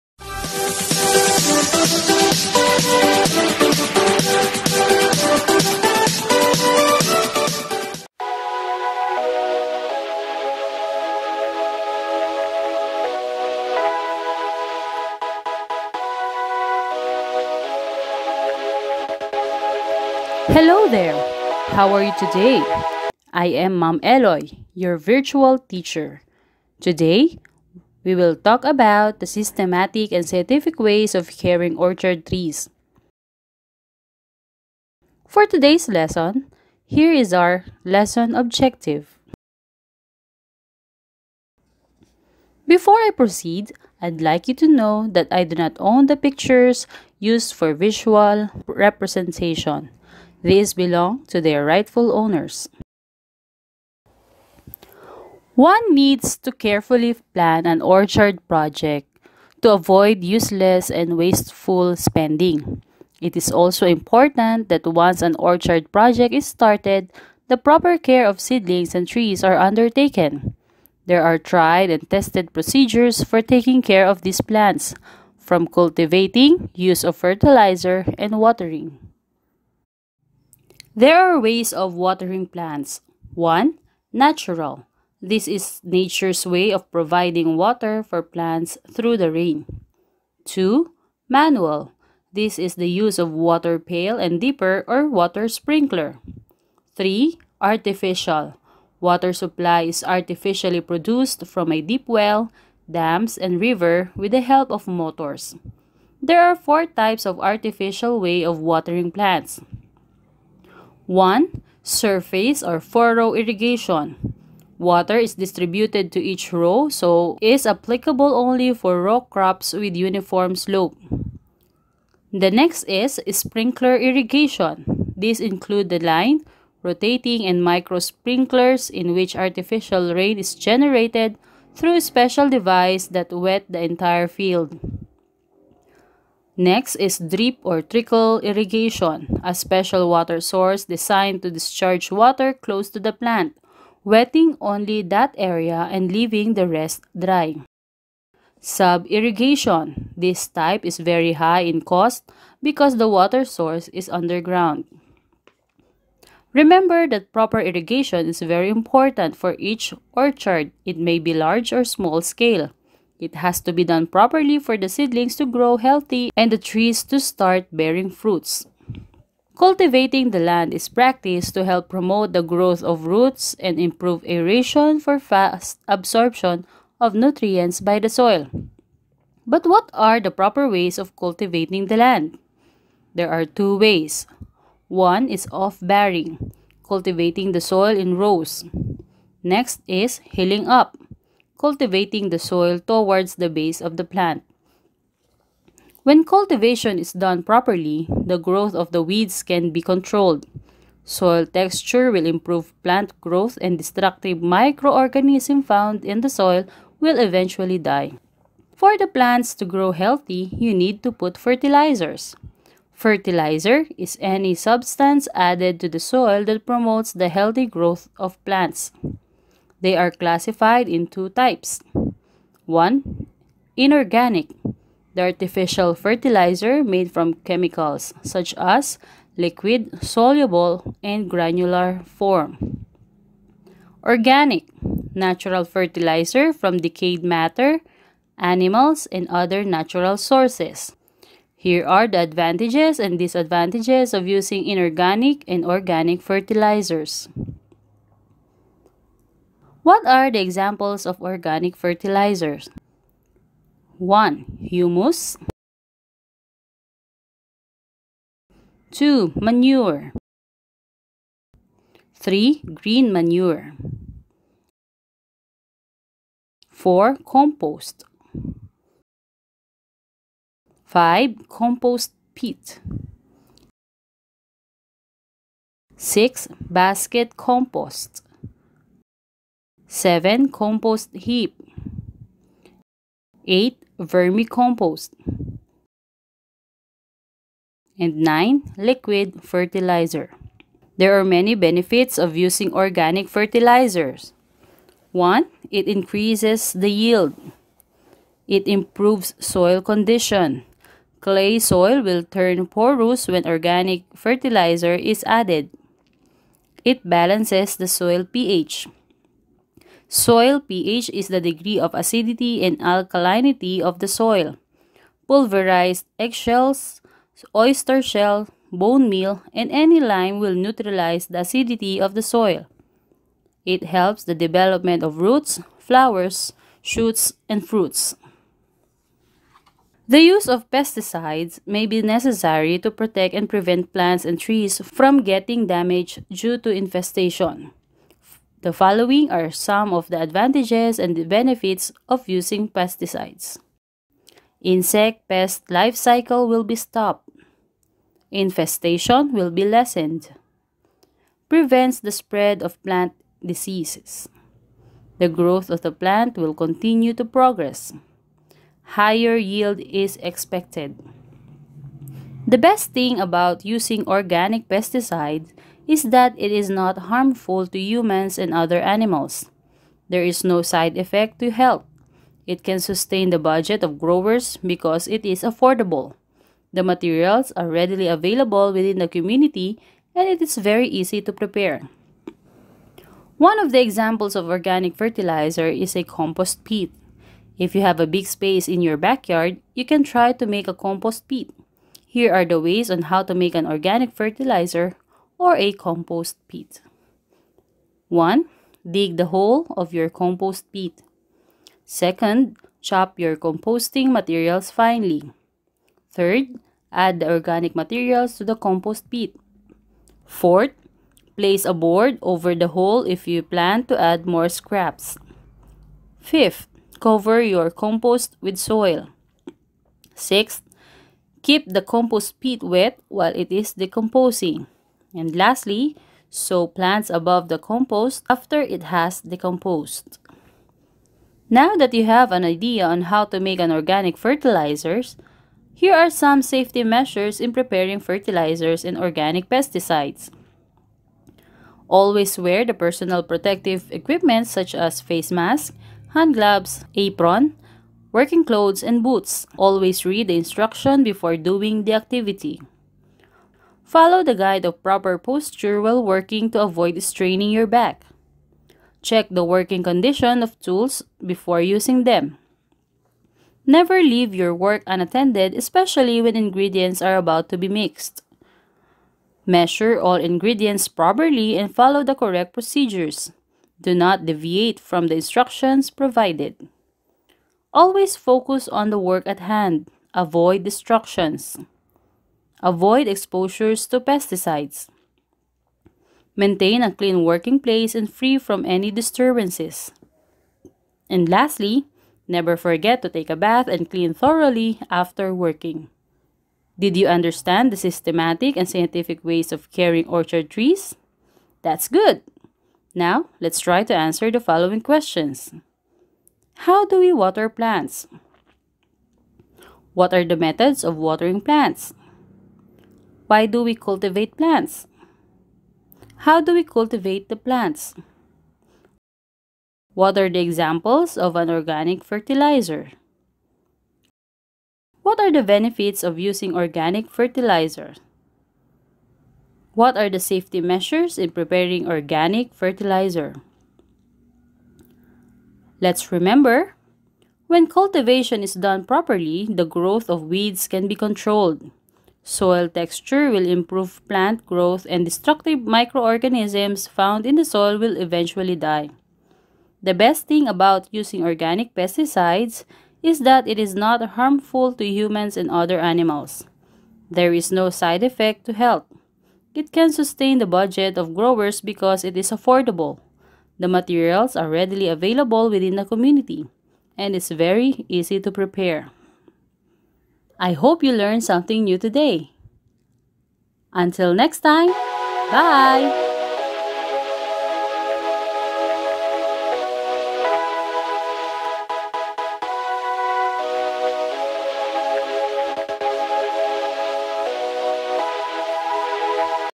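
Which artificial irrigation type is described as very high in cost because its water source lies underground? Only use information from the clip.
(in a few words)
Sub-irrigation.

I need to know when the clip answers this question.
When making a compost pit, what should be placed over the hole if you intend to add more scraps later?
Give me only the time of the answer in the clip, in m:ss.
6:51.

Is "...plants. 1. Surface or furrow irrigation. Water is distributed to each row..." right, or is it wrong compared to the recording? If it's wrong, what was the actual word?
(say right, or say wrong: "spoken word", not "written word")
right.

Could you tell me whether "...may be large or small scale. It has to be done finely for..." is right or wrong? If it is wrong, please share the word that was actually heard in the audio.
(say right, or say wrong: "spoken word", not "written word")
wrong: "properly", not "finely".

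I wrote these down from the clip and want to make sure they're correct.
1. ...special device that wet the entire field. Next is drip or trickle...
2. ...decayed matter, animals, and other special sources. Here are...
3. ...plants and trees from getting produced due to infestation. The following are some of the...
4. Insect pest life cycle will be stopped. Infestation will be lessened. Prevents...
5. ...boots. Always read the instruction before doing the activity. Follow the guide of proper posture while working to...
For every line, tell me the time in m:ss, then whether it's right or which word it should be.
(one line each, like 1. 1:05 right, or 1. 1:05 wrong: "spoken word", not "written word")
1. 2:12 right
2. 3:56 wrong: "natural", not "special"
3. 5:33 wrong: "damaged", not "produced"
4. 5:44 right
5. 7:29 right.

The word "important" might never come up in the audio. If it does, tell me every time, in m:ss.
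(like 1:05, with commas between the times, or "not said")
1:03, 2:38.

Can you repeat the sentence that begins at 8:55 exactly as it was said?
Let's remember, when cultivation is done properly, the growth of weeds can be controlled.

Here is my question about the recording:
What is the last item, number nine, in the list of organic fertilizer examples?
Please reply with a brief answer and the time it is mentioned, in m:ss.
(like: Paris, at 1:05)
Liquid fertilizer, at 4:48.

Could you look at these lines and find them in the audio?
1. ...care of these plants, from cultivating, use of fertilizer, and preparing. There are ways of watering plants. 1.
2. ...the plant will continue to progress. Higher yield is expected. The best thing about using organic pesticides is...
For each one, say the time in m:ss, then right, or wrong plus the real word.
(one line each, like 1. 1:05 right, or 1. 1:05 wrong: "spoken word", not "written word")
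1. 1:13 wrong: "watering", not "preparing"
2. 5:55 right.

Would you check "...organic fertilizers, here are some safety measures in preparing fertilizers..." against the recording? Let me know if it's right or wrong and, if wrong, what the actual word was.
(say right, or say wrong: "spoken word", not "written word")
right.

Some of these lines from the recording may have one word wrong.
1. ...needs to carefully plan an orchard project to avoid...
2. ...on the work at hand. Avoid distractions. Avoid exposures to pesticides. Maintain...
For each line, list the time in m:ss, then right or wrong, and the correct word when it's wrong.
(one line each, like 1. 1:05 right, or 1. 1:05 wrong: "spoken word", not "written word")
1. 0:55 right
2. 7:58 right.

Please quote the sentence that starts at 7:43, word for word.
Never leave your work unattended, especially when ingredients are about to be mixed.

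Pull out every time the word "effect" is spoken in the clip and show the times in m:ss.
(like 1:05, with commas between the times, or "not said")
6:10, 9:18.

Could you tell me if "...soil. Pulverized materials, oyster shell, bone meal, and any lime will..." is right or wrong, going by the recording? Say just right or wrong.
wrong.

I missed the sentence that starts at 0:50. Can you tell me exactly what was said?
These belong to their rightful owners.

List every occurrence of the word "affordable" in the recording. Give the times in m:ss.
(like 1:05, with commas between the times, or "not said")
6:15, 9:22.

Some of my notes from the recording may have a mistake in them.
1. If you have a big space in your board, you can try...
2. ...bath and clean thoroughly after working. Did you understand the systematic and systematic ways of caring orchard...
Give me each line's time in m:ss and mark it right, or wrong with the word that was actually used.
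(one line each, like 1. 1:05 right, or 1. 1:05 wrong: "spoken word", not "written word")
1. 6:27 wrong: "backyard", not "board"
2. 8:13 wrong: "scientific", not "systematic".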